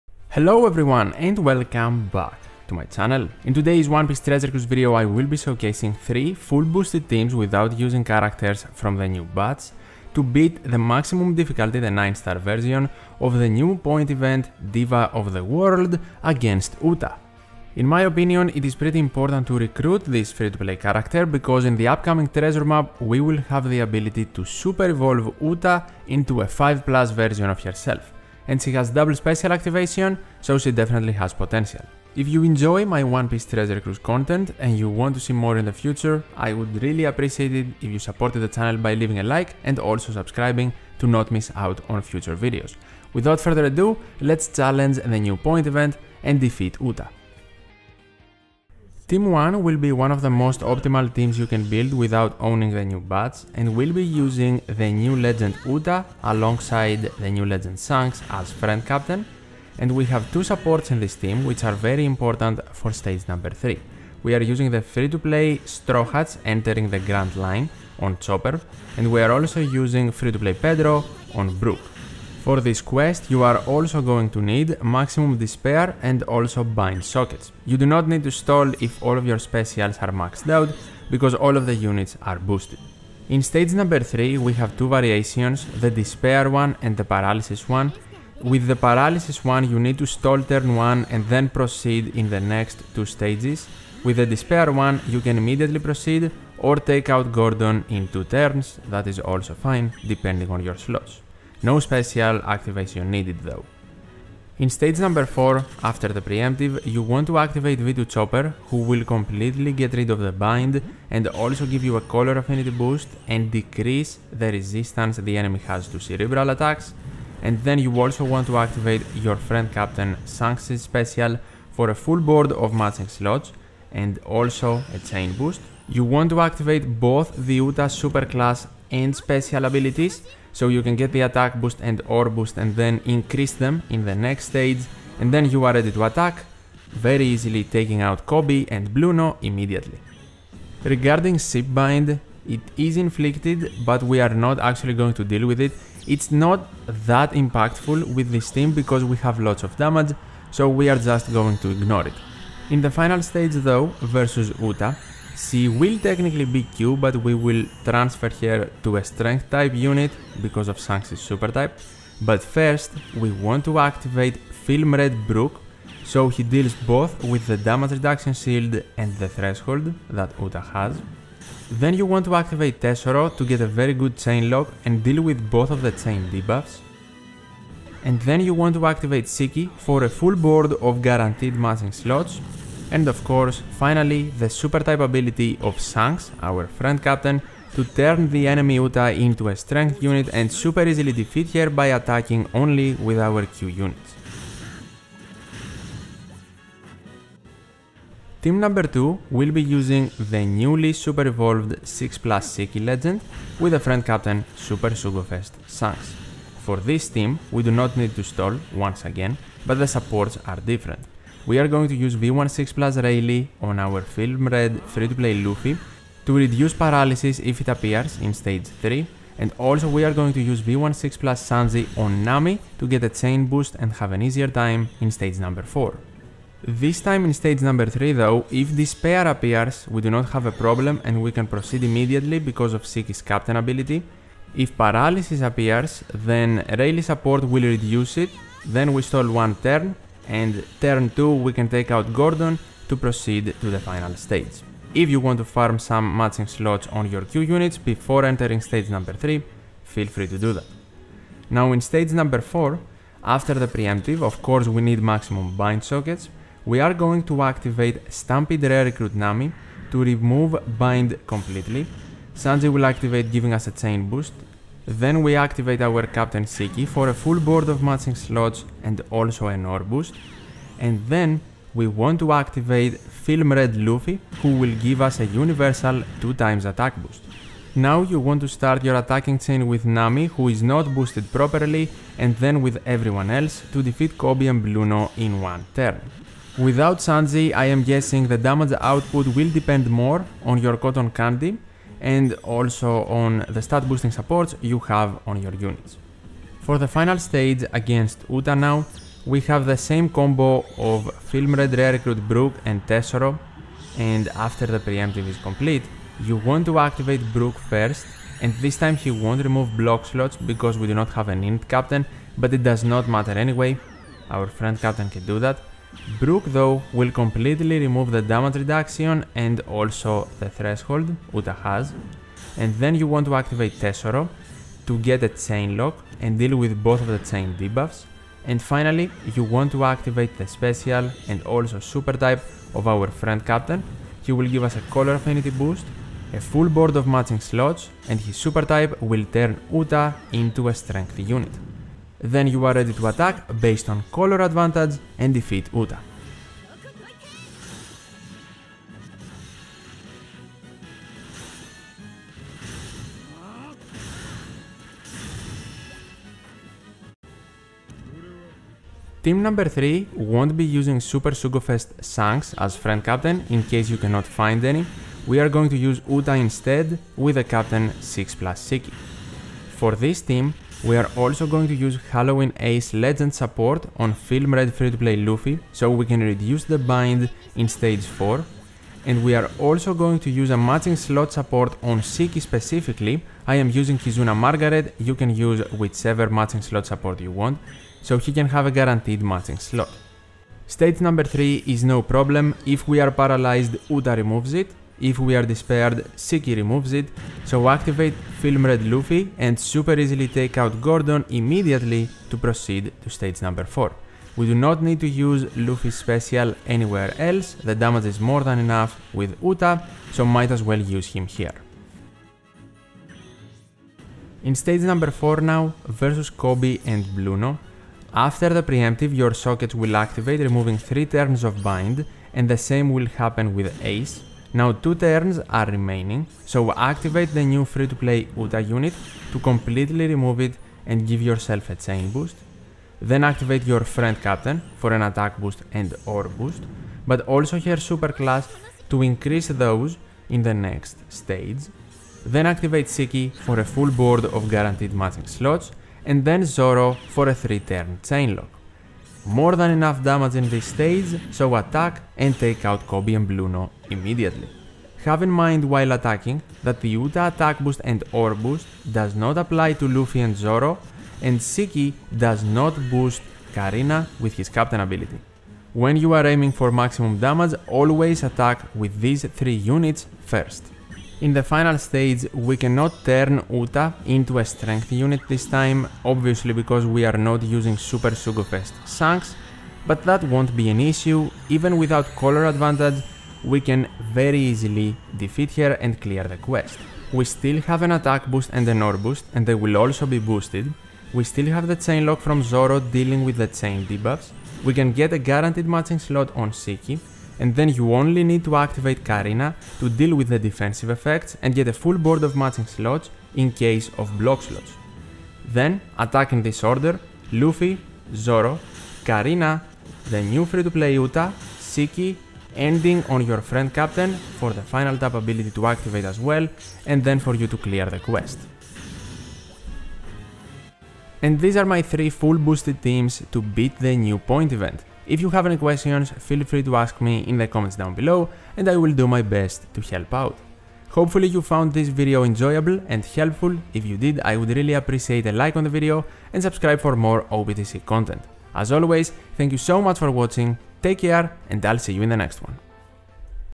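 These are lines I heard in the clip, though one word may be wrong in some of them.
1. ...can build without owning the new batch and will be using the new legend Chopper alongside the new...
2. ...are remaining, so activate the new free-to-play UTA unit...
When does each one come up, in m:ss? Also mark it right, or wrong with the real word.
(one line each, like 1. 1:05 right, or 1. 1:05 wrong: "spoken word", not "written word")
1. 0:51 wrong: "Uta", not "Chopper"
2. 7:05 right.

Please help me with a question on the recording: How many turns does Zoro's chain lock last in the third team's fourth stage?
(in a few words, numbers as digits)
3.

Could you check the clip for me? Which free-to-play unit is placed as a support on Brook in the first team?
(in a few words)
Pedro.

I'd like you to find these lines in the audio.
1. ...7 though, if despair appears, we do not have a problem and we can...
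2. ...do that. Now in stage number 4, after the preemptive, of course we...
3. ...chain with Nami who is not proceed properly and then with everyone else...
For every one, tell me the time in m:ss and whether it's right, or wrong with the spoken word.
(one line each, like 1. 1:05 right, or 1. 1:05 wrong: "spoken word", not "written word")
1. 3:47 wrong: "3", not "7"
2. 4:10 right
3. 4:39 wrong: "boosted", not "proceed".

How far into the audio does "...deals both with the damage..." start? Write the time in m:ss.
2:46.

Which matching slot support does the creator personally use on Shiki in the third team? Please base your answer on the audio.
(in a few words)
Kizuna Margaret.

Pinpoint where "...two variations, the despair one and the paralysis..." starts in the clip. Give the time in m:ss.
1:24.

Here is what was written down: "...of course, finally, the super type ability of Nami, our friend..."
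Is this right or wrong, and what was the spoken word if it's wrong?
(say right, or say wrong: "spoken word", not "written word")
wrong: "Shanks", not "Nami".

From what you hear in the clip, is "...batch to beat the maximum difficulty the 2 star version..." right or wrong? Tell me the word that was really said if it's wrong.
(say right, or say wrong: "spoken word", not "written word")
wrong: "9", not "2".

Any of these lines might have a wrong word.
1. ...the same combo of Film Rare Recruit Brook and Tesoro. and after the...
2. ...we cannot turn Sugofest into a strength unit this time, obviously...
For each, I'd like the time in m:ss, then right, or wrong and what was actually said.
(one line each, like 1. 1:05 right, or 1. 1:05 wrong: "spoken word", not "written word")
1. 4:59 right
2. 7:52 wrong: "Uta", not "Sugofest".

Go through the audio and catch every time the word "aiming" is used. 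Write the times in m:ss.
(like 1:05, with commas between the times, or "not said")
7:46.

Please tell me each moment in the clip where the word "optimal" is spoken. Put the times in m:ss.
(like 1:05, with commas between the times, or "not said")
0:50.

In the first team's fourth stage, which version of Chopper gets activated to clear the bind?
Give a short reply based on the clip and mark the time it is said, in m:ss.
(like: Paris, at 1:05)
V2, at 1:47.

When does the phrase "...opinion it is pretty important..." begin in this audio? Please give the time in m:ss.
0:18.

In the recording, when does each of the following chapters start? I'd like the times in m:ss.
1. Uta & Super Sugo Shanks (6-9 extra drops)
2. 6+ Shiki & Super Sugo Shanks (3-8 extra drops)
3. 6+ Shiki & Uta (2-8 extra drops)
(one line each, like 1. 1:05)
1. 0:49
2. 3:18
3. 5:58.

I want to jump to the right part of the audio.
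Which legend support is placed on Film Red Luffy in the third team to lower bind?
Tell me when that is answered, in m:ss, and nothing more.
6:12.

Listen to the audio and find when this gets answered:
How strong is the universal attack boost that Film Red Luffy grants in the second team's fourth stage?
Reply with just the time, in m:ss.
4:36.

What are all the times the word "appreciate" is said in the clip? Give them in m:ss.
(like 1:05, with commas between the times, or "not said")
0:37, 8:54.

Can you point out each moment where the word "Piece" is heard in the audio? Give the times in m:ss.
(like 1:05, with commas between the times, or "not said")
0:04, 0:33.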